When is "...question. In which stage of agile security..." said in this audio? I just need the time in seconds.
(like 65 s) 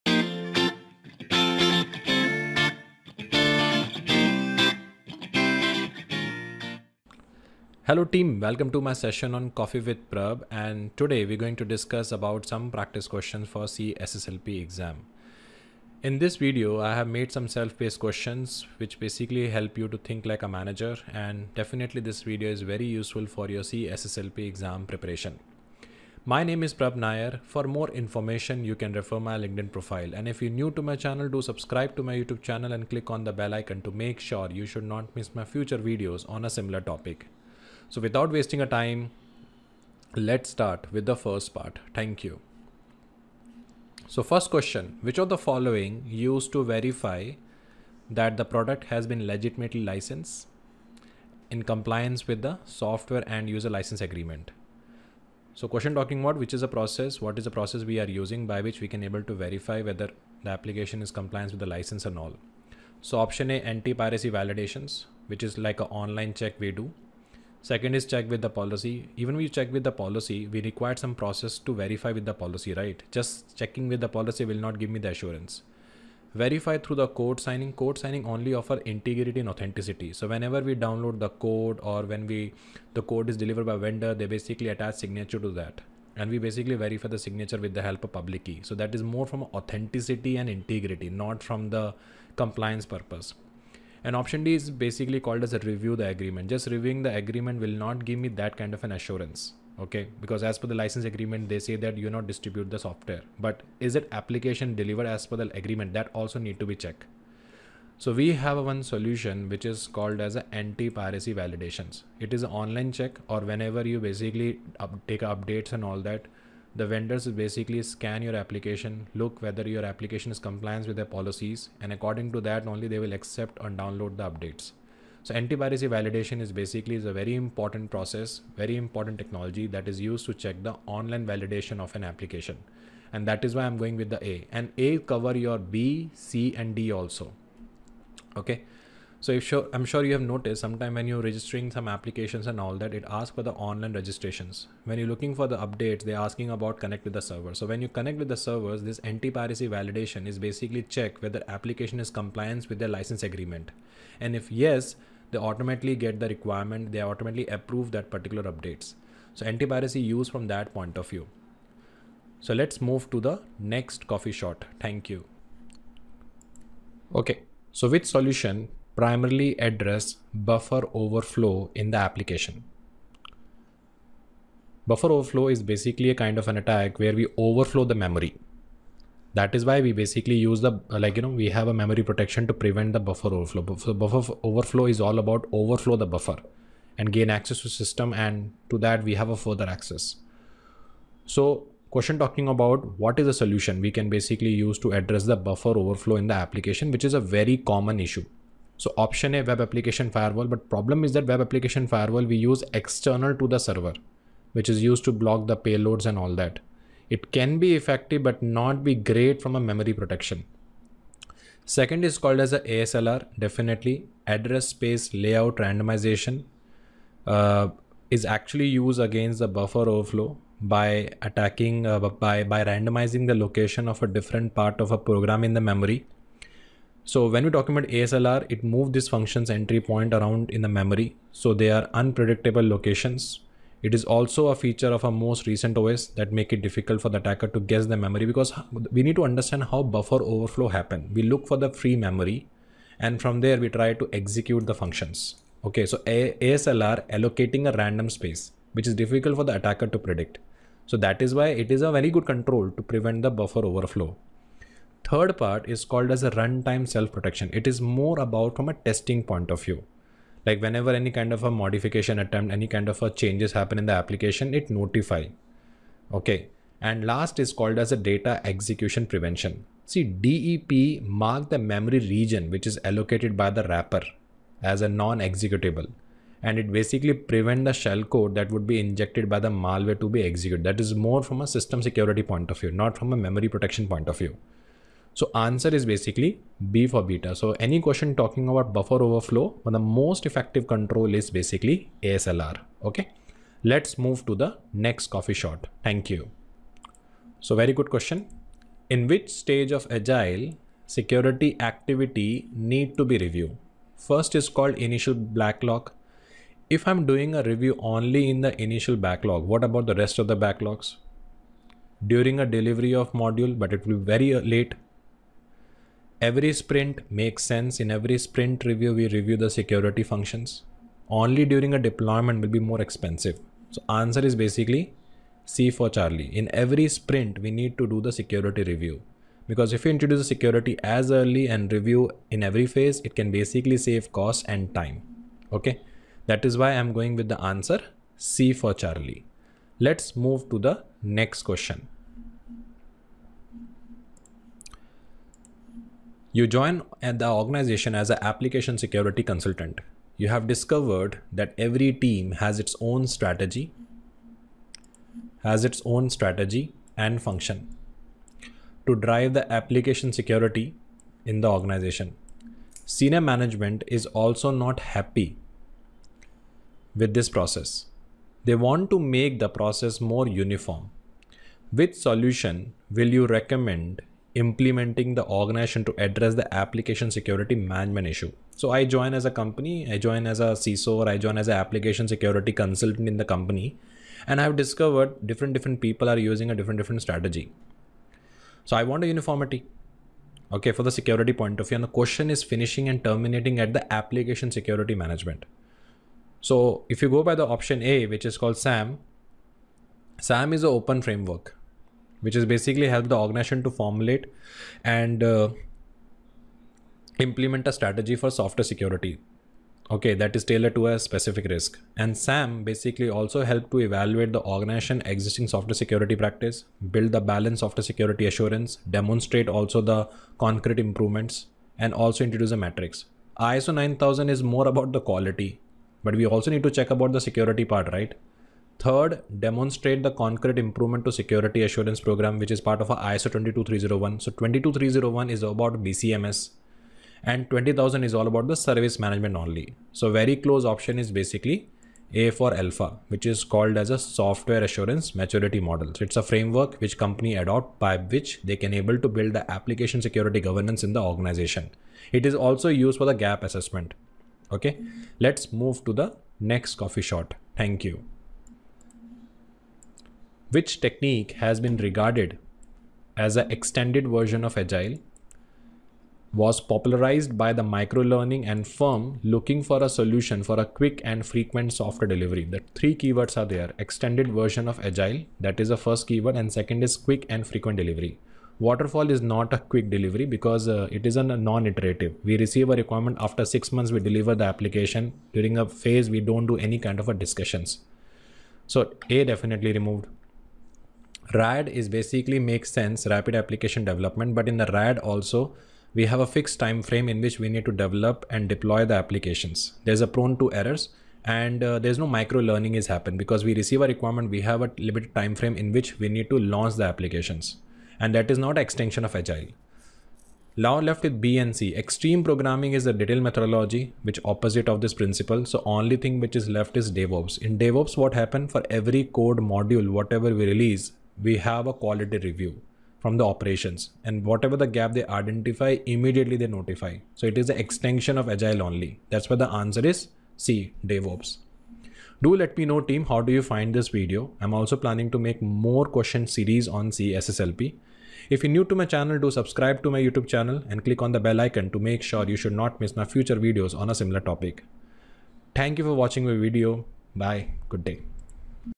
297 s.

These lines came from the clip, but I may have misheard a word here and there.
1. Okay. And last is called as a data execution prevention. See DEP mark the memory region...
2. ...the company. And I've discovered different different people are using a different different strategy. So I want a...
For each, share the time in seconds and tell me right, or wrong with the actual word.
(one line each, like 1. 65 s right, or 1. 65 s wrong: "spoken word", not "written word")
1. 266 s right
2. 383 s right.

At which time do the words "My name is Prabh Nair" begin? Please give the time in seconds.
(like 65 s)
26 s.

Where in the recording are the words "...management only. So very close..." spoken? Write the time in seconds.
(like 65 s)
438 s.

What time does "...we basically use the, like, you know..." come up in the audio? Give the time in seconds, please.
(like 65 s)
179 s.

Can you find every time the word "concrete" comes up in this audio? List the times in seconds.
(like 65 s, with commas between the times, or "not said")
420 s, 430 s.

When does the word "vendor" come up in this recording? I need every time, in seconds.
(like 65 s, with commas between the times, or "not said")
83 s, 116 s.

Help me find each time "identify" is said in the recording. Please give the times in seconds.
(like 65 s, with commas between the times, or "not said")
525 s.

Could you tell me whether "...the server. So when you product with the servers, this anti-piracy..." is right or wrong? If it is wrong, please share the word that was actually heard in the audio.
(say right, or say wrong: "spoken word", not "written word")
wrong: "connect", not "product".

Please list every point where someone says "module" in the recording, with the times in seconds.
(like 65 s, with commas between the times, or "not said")
313 s, 519 s.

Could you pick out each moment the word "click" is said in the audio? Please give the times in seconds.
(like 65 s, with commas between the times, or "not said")
32 s, 540 s.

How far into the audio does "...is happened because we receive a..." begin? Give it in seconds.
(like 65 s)
502 s.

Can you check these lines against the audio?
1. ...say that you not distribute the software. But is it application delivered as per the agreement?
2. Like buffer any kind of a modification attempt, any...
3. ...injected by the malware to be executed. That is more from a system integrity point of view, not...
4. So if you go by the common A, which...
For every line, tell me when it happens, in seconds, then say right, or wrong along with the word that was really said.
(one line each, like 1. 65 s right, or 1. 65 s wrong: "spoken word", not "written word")
1. 101 s right
2. 260 s wrong: "whenever", not "buffer"
3. 278 s wrong: "security", not "integrity"
4. 396 s wrong: "option", not "common".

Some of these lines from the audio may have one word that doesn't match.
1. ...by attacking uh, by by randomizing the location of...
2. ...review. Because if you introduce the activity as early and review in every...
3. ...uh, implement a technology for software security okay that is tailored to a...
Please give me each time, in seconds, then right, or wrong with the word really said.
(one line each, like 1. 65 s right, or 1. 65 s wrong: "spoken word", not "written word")
1. 220 s right
2. 328 s wrong: "security", not "activity"
3. 405 s wrong: "strategy", not "technology".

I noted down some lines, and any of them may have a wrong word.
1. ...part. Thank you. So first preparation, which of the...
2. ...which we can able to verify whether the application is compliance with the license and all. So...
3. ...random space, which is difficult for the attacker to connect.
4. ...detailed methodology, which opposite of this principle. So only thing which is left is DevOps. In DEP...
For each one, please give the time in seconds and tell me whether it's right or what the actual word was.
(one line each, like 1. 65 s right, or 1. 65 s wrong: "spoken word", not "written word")
1. 41 s wrong: "question", not "preparation"
2. 58 s right
3. 247 s wrong: "predict", not "connect"
4. 512 s wrong: "DevOps", not "DEP".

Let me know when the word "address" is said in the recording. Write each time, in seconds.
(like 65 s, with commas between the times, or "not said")
169 s, 194 s, 214 s, 375 s.